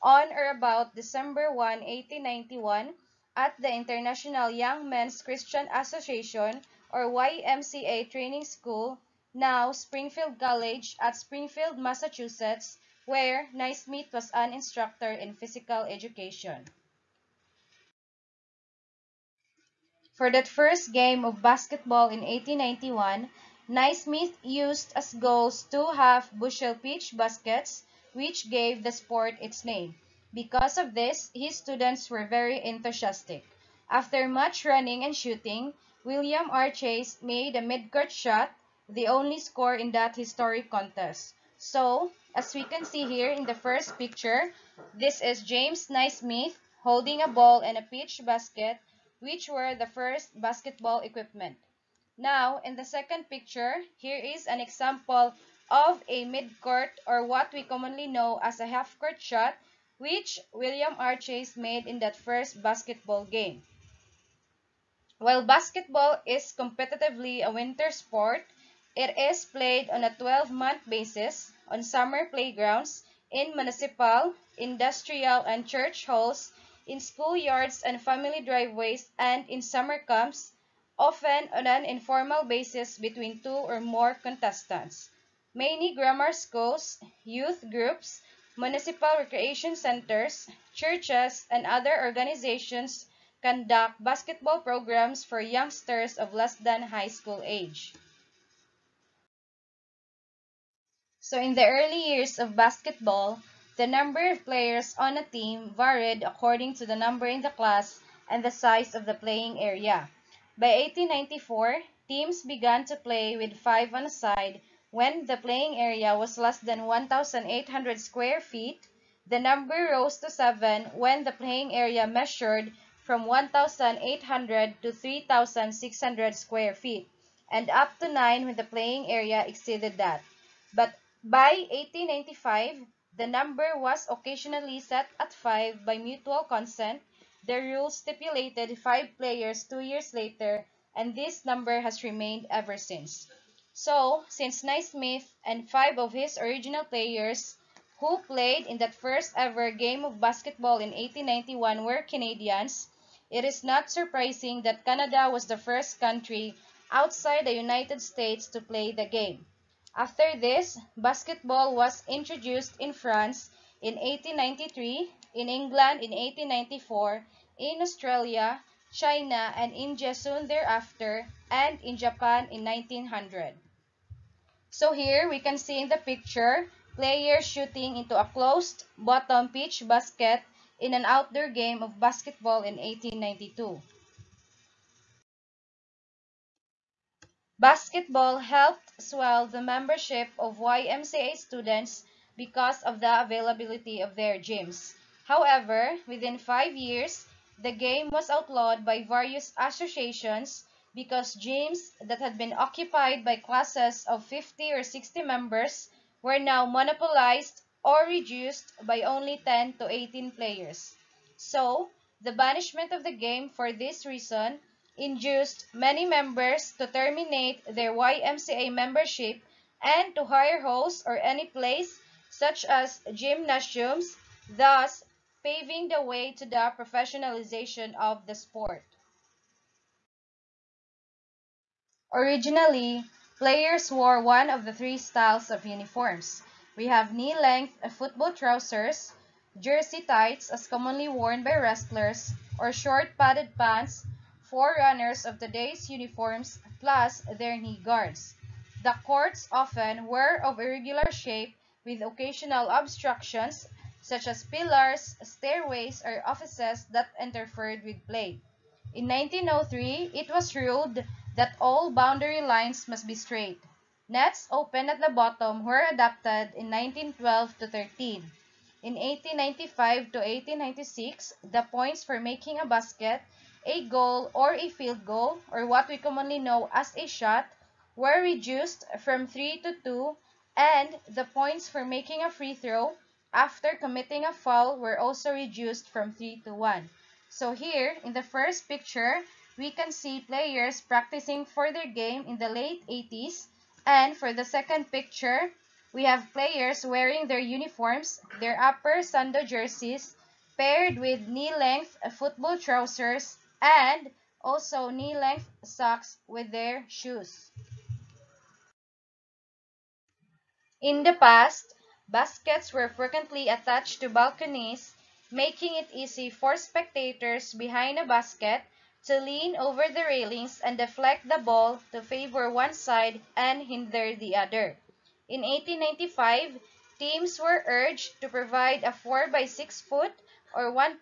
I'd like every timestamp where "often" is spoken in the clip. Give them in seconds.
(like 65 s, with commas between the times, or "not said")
80 s, 249 s.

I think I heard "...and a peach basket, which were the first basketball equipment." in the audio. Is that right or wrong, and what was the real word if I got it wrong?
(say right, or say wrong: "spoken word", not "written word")
right.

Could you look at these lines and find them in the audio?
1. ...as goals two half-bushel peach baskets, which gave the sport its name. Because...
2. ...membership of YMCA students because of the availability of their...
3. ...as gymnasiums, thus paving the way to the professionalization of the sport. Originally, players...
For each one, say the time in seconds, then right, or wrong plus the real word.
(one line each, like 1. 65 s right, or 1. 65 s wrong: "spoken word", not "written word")
1. 24 s right
2. 189 s right
3. 222 s right.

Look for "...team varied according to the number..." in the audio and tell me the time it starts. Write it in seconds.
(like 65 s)
105 s.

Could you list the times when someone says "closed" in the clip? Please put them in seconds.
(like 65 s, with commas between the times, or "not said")
178 s.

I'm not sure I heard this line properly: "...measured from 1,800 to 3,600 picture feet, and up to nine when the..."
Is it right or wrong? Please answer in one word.
wrong.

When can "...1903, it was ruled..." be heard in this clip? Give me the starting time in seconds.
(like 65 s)
259 s.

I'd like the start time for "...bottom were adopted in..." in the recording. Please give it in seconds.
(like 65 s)
265 s.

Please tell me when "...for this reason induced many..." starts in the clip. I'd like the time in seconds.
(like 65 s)
213 s.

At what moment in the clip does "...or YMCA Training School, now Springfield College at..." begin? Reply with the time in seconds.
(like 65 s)
6 s.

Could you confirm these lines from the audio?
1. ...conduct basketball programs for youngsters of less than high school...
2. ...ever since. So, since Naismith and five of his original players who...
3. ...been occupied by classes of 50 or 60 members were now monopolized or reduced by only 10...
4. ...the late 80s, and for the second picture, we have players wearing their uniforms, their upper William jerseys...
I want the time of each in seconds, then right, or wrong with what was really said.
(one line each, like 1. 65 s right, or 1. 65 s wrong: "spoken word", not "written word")
1. 93 s right
2. 142 s right
3. 202 s right
4. 292 s wrong: "Sando", not "William".